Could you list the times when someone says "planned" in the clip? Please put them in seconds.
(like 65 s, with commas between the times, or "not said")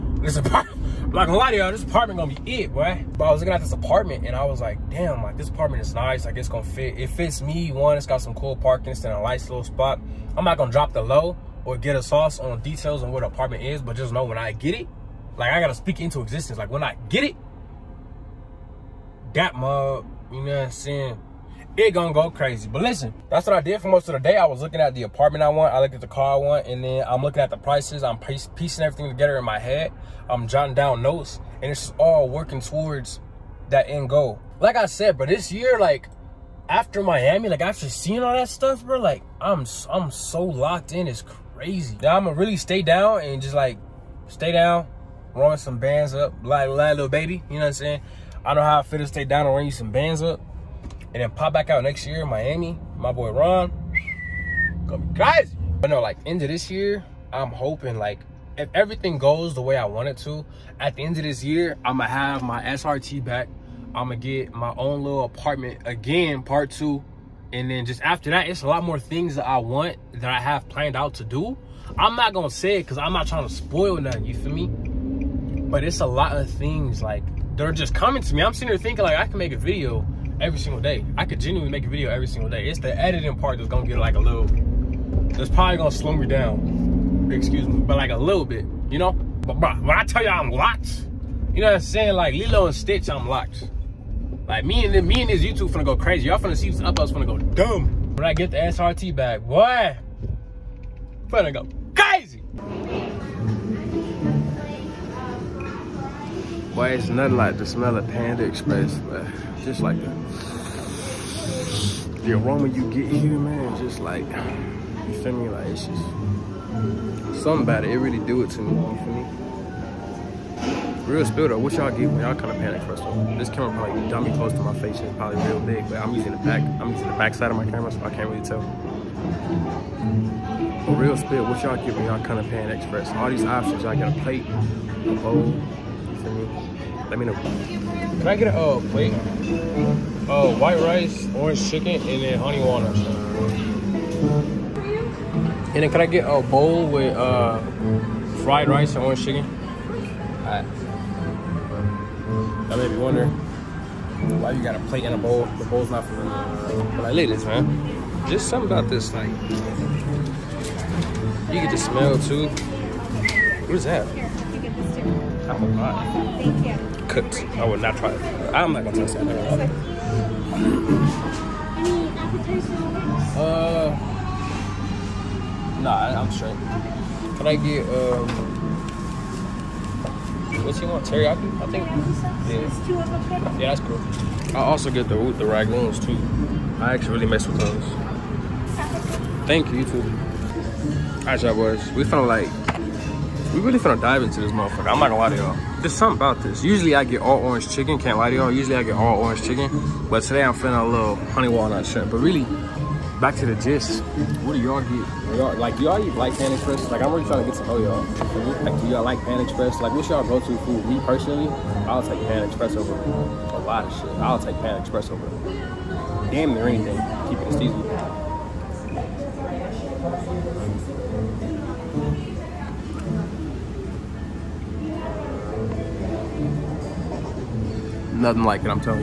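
70 s.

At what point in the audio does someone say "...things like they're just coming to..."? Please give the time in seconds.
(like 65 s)
76 s.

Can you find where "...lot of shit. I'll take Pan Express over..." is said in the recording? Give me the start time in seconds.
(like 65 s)
213 s.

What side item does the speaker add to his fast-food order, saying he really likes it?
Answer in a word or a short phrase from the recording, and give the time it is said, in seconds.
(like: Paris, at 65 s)
Rangoons, at 185 s.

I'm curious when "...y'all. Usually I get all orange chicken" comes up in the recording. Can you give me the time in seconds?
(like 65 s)
198 s.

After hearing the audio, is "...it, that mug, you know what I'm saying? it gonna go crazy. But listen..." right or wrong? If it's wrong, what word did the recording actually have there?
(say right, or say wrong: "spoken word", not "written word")
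right.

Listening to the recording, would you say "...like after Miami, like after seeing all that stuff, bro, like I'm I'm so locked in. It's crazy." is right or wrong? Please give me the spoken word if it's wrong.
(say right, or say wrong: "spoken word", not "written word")
right.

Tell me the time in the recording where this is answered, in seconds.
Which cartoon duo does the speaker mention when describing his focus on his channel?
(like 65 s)
92 s.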